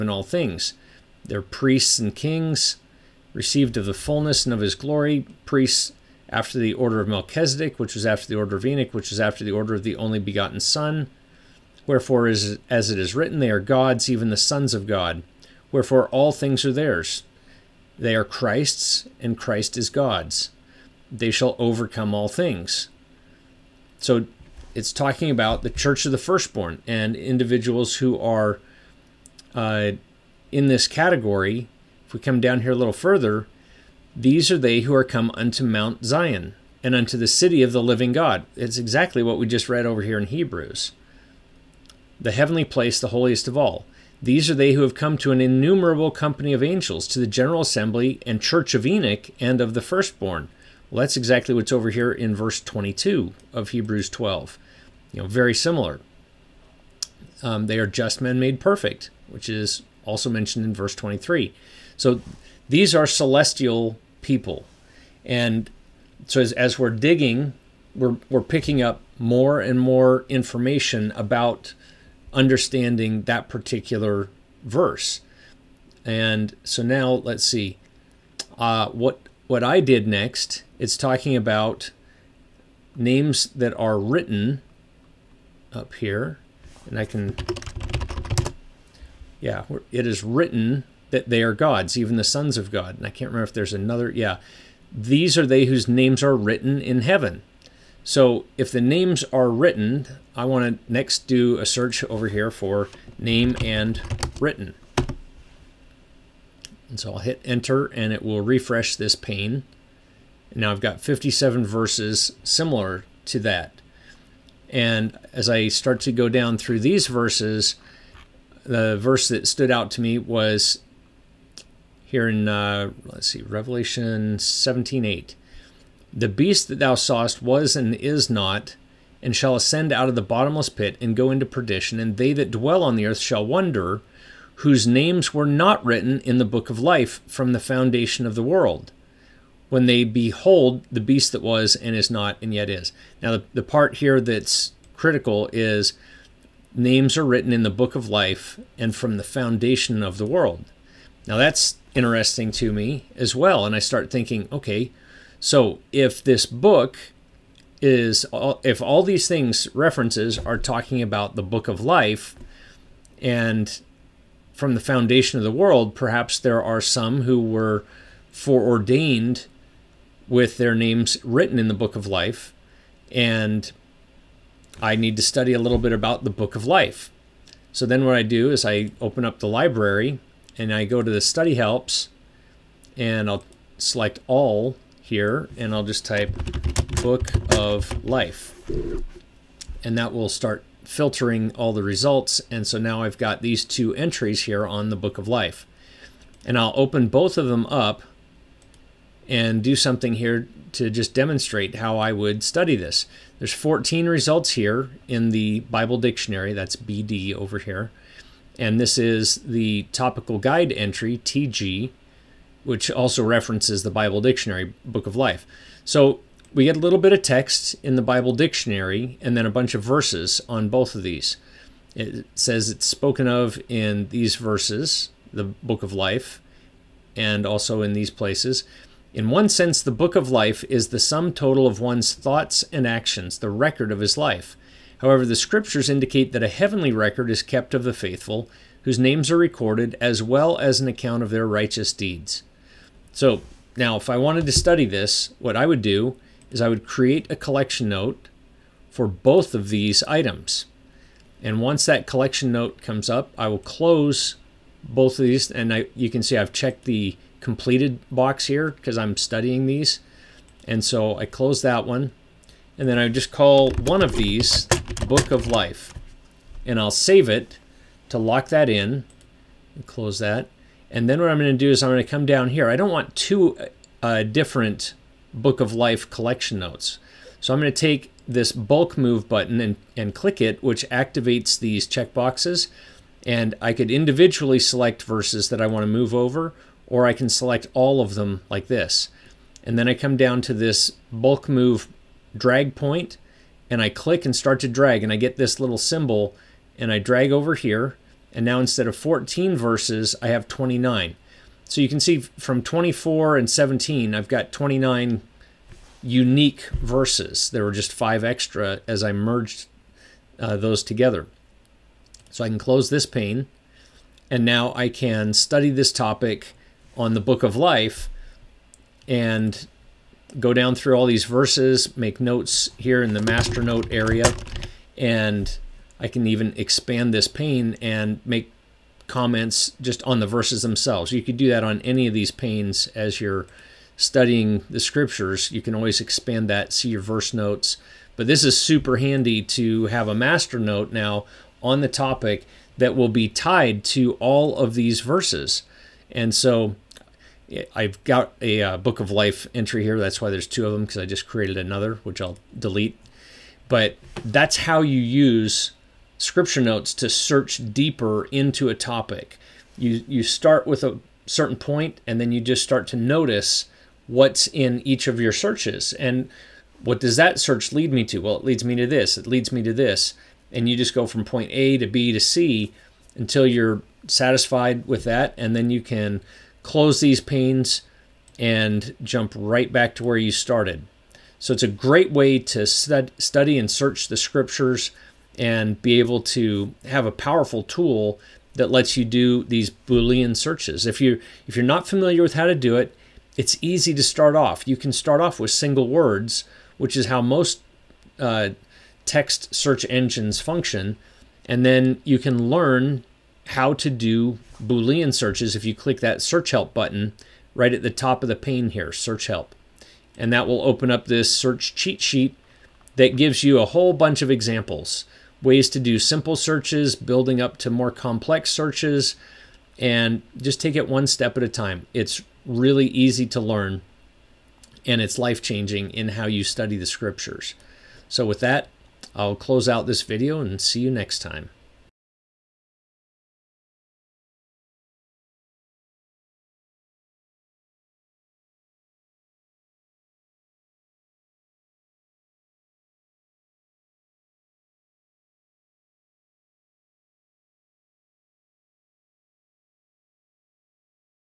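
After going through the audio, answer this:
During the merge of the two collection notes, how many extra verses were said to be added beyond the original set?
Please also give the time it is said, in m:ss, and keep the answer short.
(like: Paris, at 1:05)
5, at 5:07.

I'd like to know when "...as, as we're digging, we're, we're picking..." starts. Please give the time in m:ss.
1:06.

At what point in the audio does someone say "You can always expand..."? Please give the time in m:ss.
5:35.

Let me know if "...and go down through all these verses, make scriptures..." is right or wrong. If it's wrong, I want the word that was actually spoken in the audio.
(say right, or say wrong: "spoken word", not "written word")
wrong: "notes", not "scriptures".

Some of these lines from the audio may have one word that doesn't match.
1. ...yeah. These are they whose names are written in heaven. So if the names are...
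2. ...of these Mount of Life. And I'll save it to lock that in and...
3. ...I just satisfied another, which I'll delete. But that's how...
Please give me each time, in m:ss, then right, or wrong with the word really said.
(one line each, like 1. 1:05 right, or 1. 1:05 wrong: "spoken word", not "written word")
1. 1:34 right
2. 4:24 wrong: "Book", not "Mount"
3. 5:50 wrong: "created", not "satisfied".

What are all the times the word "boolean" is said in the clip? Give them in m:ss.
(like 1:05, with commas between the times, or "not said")
6:29, 6:44.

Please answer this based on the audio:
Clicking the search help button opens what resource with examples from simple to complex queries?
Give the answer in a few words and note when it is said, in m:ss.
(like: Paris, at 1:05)
search cheat sheet, at 6:51.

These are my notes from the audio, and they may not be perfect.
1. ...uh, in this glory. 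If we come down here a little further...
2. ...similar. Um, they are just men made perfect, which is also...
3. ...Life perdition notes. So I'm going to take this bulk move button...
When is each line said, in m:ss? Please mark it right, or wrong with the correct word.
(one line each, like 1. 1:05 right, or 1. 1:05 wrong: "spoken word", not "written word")
1. 0:29 wrong: "category", not "glory"
2. 0:55 right
3. 4:35 wrong: "collection", not "perdition".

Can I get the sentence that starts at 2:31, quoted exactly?
Now, that's interesting to me as well.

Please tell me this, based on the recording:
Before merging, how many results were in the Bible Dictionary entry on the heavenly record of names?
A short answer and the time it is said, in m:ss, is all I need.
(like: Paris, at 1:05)
14, at 3:23.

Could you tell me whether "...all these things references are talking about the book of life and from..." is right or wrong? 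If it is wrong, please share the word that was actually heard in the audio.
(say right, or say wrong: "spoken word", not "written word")
right.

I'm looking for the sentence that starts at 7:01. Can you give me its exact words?
It's really easy to learn and it's life changing in how you study the scriptures.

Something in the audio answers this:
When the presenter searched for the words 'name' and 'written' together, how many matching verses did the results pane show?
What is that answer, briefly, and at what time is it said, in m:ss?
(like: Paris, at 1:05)
57, at 1:50.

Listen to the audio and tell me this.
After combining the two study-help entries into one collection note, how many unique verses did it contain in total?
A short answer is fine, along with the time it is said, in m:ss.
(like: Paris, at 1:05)
29, at 5:04.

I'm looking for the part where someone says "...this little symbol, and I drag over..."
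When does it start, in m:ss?
4:55.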